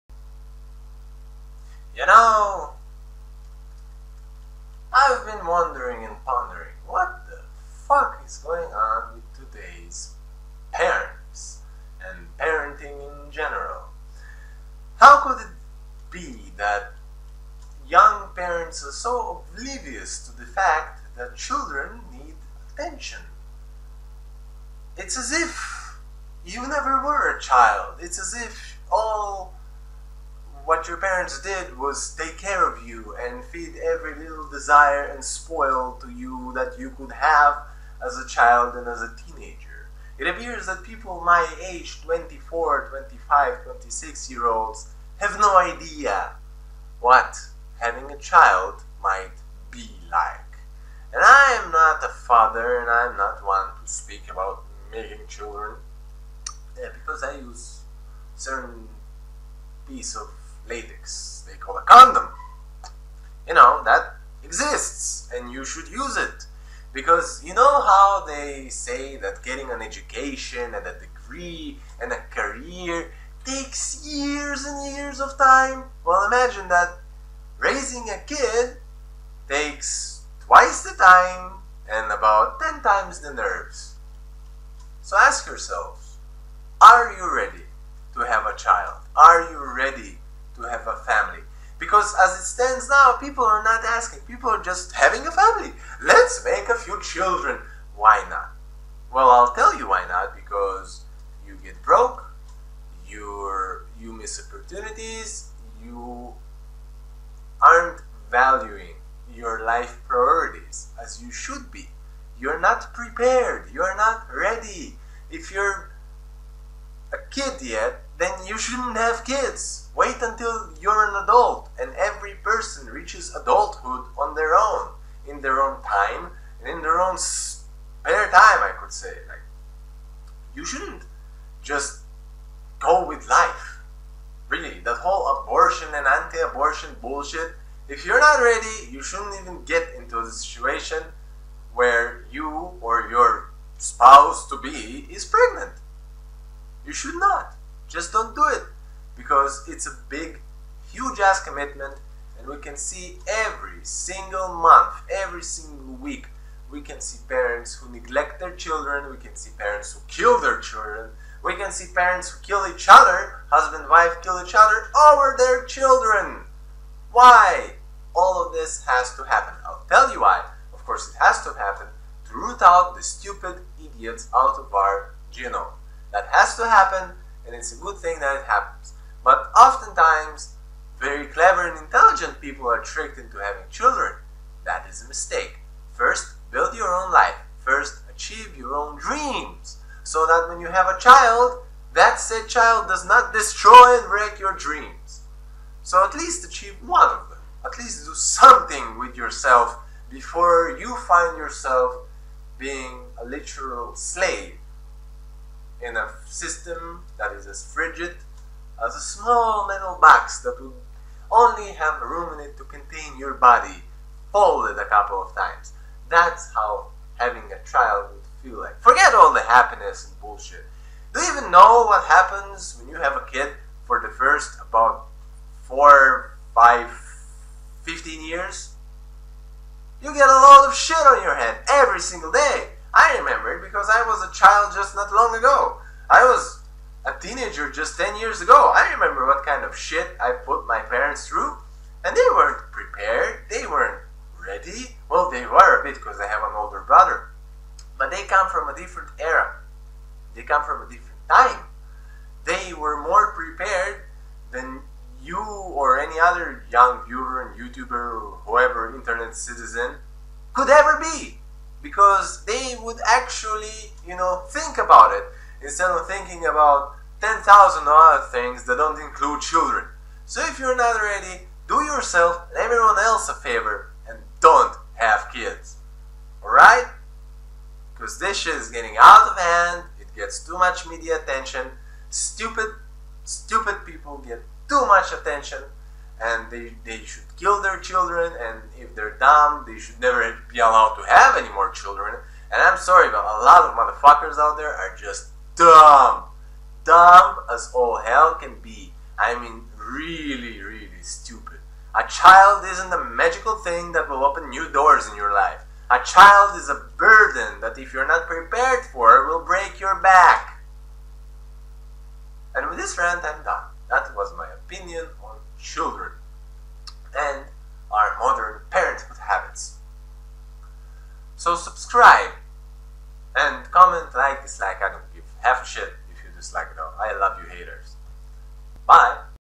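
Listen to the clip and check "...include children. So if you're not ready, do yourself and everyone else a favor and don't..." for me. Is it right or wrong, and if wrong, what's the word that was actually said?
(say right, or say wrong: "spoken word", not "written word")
right.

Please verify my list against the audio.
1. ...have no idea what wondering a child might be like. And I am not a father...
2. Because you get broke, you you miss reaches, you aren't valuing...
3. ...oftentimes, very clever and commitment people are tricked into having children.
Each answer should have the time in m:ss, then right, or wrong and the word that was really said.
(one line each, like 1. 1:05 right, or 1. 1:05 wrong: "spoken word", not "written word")
1. 0:45 wrong: "having", not "wondering"
2. 1:40 wrong: "opportunities", not "reaches"
3. 2:59 wrong: "intelligent", not "commitment".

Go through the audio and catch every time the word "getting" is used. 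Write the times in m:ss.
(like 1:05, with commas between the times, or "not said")
1:09, 4:38.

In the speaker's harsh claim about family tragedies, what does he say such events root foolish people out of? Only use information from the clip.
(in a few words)
our genome.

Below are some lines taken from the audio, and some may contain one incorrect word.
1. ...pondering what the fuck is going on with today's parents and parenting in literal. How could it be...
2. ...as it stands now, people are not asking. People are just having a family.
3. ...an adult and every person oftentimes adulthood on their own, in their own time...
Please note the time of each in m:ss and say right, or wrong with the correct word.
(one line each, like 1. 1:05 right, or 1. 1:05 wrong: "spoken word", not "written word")
1. 0:06 wrong: "general", not "literal"
2. 1:32 right
3. 2:01 wrong: "reaches", not "oftentimes".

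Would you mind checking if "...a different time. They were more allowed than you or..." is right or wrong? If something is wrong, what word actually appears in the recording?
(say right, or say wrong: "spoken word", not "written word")
wrong: "prepared", not "allowed".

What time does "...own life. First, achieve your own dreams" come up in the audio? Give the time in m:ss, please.
3:06.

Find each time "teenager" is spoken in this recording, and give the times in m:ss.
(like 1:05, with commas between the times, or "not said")
0:39, 3:57.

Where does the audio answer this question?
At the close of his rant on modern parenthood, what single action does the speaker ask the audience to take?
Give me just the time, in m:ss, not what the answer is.
5:21.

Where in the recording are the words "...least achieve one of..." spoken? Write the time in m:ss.
3:16.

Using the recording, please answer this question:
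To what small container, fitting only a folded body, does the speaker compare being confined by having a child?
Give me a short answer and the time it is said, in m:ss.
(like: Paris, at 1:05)
metal box, at 3:29.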